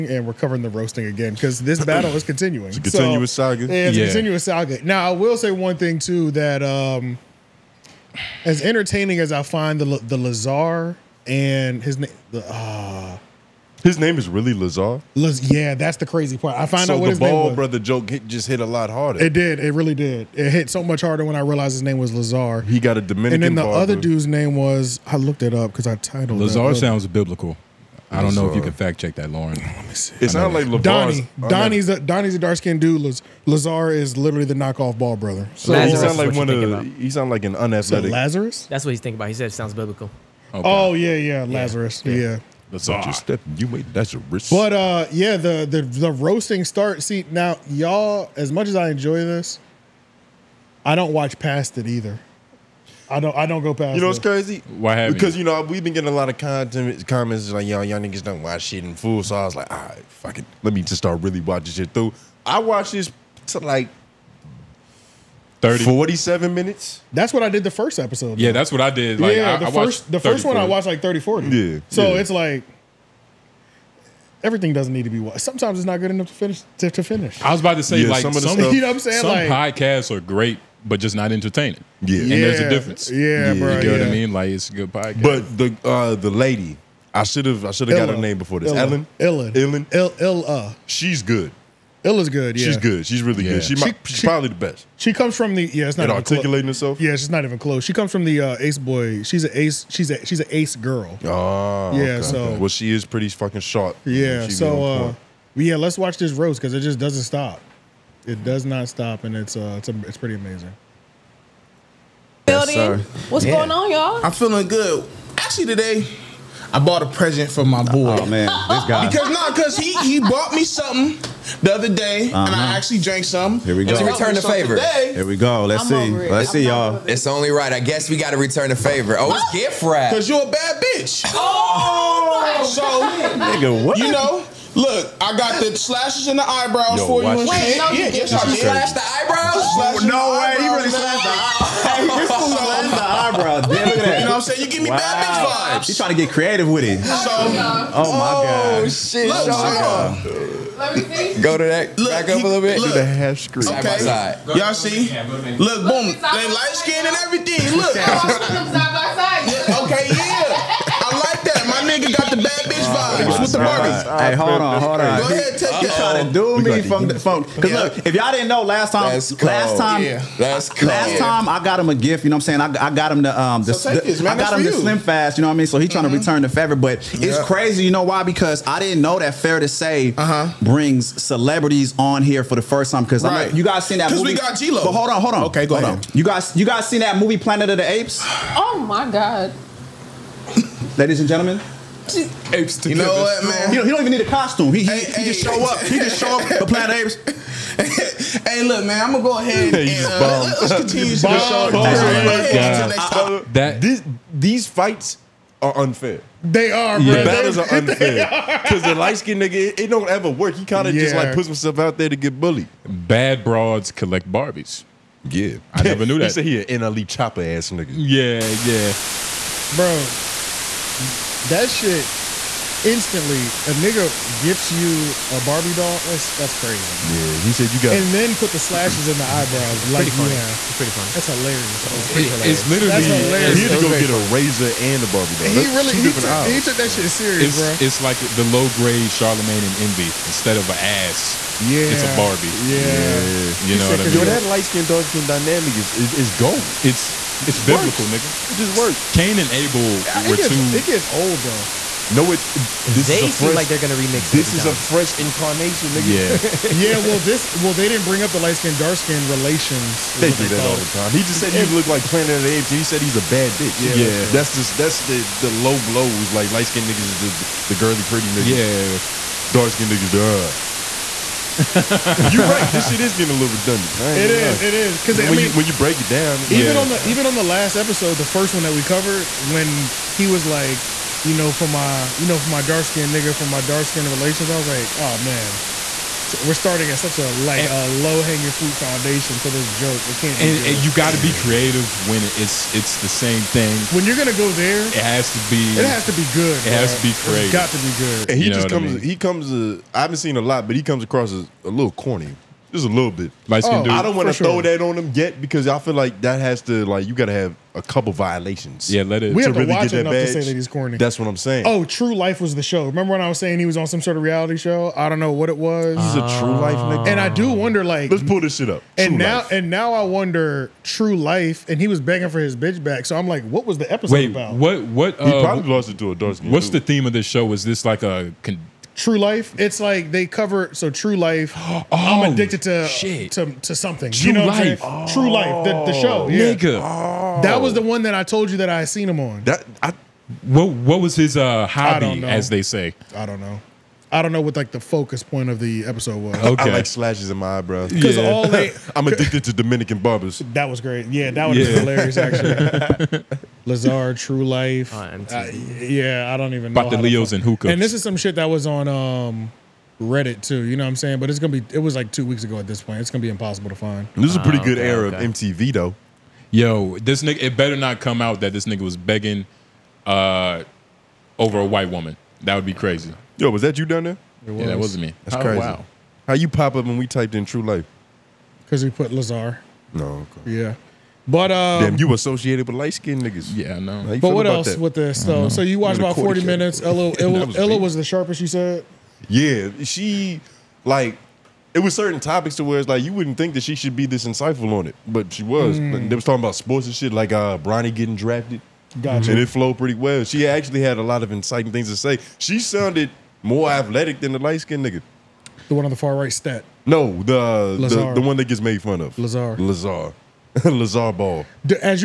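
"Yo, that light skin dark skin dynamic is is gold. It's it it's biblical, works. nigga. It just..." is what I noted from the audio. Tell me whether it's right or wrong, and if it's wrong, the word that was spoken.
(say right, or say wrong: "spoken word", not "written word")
right.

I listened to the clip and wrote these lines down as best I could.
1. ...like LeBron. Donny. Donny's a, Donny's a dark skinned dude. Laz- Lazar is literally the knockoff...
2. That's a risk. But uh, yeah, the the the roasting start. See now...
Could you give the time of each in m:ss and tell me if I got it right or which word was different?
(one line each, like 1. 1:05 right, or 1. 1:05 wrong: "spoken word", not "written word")
1. 0:30 right
2. 0:43 right.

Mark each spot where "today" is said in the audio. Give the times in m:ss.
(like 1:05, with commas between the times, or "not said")
1:55, 2:04.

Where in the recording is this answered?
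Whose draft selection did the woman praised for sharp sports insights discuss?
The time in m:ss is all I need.
6:37.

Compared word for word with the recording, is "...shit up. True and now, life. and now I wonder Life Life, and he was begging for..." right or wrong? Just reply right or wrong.
wrong.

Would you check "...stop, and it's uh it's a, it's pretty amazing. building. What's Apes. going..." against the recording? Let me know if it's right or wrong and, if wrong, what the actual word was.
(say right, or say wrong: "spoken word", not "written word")
wrong: "Yeah", not "Apes".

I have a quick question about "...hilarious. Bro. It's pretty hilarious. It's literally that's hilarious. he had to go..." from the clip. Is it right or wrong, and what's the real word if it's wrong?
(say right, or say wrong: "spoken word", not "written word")
right.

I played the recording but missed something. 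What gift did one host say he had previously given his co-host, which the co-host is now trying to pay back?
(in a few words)
Slim Fast.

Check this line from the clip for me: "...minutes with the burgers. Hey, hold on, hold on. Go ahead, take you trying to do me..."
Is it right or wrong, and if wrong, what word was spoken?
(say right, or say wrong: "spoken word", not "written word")
wrong: "vibes", not "minutes".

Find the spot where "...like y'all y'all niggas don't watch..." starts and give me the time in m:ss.
0:57.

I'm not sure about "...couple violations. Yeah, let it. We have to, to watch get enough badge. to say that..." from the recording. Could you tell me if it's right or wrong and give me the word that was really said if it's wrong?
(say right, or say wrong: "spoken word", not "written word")
right.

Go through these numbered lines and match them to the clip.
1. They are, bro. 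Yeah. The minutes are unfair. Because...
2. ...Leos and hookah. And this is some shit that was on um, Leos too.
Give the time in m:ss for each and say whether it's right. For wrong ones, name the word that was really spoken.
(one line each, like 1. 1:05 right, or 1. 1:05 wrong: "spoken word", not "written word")
1. 3:26 wrong: "battles", not "minutes"
2. 5:57 wrong: "Reddit", not "Leos".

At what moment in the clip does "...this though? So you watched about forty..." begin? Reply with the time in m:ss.
6:24.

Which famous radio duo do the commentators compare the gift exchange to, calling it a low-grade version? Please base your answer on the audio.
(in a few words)
Charlemagne and Envy.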